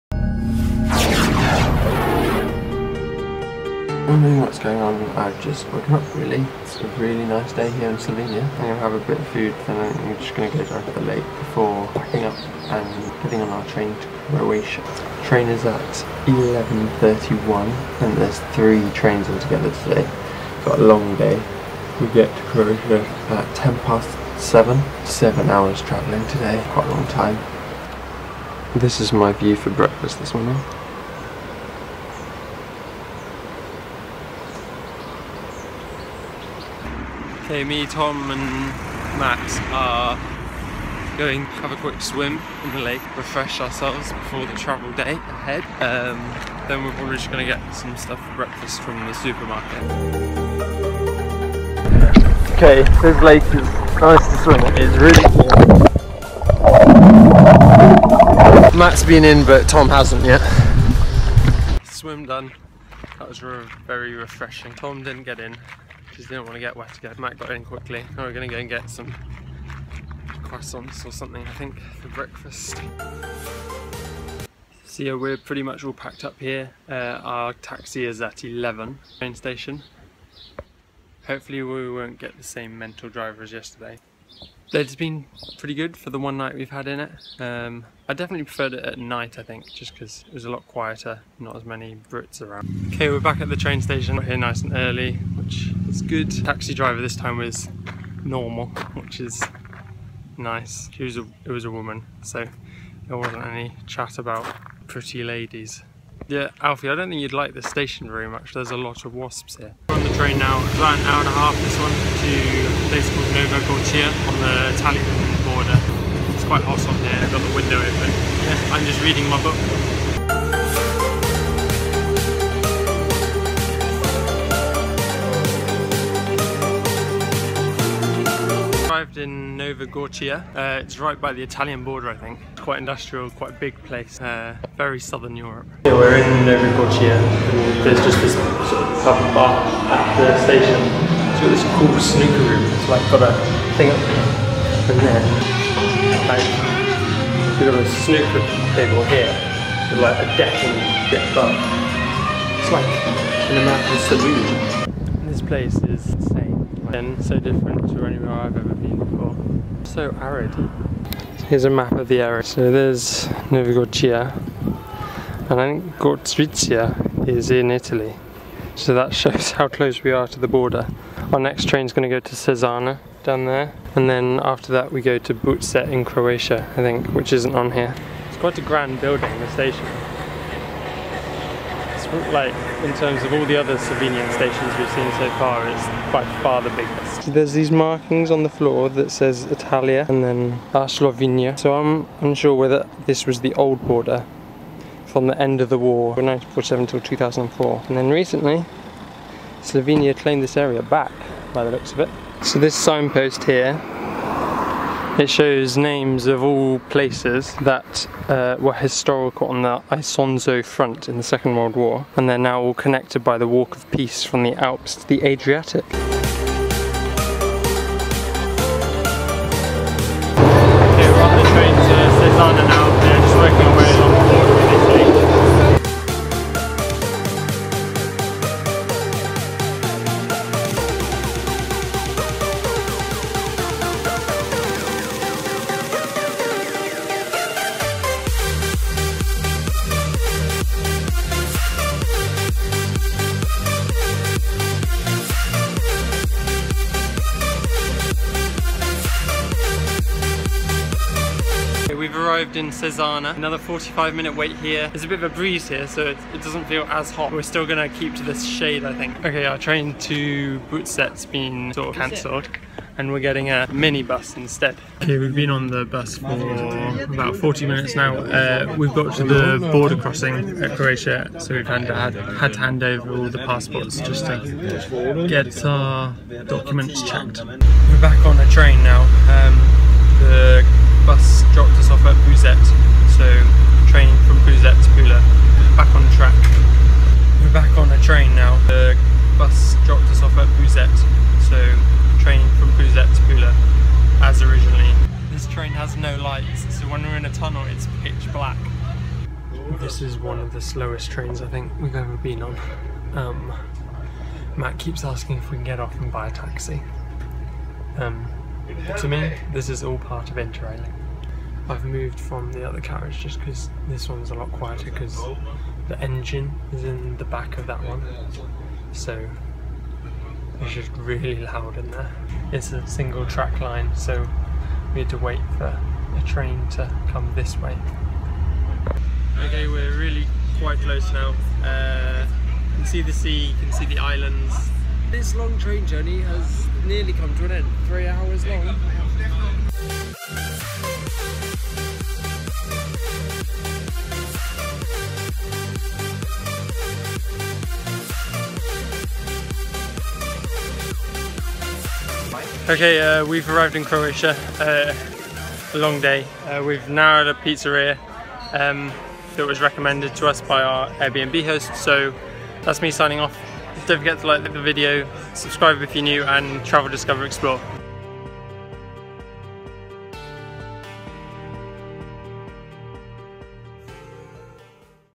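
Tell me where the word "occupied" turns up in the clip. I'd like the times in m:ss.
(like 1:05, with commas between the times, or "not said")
not said.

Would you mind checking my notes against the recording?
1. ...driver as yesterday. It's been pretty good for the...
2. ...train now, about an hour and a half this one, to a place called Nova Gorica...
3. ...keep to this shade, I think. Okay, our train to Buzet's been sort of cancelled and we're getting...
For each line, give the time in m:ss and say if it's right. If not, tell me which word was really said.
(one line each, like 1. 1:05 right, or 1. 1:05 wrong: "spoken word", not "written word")
1. 1:23 right
2. 1:50 right
3. 4:17 right.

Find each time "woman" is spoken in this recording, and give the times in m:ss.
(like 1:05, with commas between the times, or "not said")
1:41.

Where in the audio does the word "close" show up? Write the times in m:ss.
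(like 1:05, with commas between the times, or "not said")
2:49, 5:30.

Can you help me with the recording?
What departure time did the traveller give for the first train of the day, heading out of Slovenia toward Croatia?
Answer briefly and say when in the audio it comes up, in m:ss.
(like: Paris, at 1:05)
11:31, at 0:16.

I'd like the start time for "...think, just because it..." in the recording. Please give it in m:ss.
1:29.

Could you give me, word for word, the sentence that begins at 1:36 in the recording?
Taxi driver this time was normal, which is nice.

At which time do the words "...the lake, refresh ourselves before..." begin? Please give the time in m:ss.
0:42.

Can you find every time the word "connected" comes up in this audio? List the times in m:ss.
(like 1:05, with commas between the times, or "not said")
3:32.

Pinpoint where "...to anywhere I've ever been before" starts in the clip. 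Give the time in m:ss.
2:37.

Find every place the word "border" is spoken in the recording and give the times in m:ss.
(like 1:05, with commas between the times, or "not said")
1:55, 2:11, 2:50, 3:13, 4:29.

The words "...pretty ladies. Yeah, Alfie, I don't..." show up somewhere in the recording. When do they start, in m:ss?
1:44.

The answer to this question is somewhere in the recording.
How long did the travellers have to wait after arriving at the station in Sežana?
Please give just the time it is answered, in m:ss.
4:13.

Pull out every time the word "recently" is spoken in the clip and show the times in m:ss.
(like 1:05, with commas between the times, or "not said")
3:18.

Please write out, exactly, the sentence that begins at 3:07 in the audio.
There's these markings on the floor that says Italia and then uh, Slovenia.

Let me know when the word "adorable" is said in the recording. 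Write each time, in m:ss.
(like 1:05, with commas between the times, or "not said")
not said.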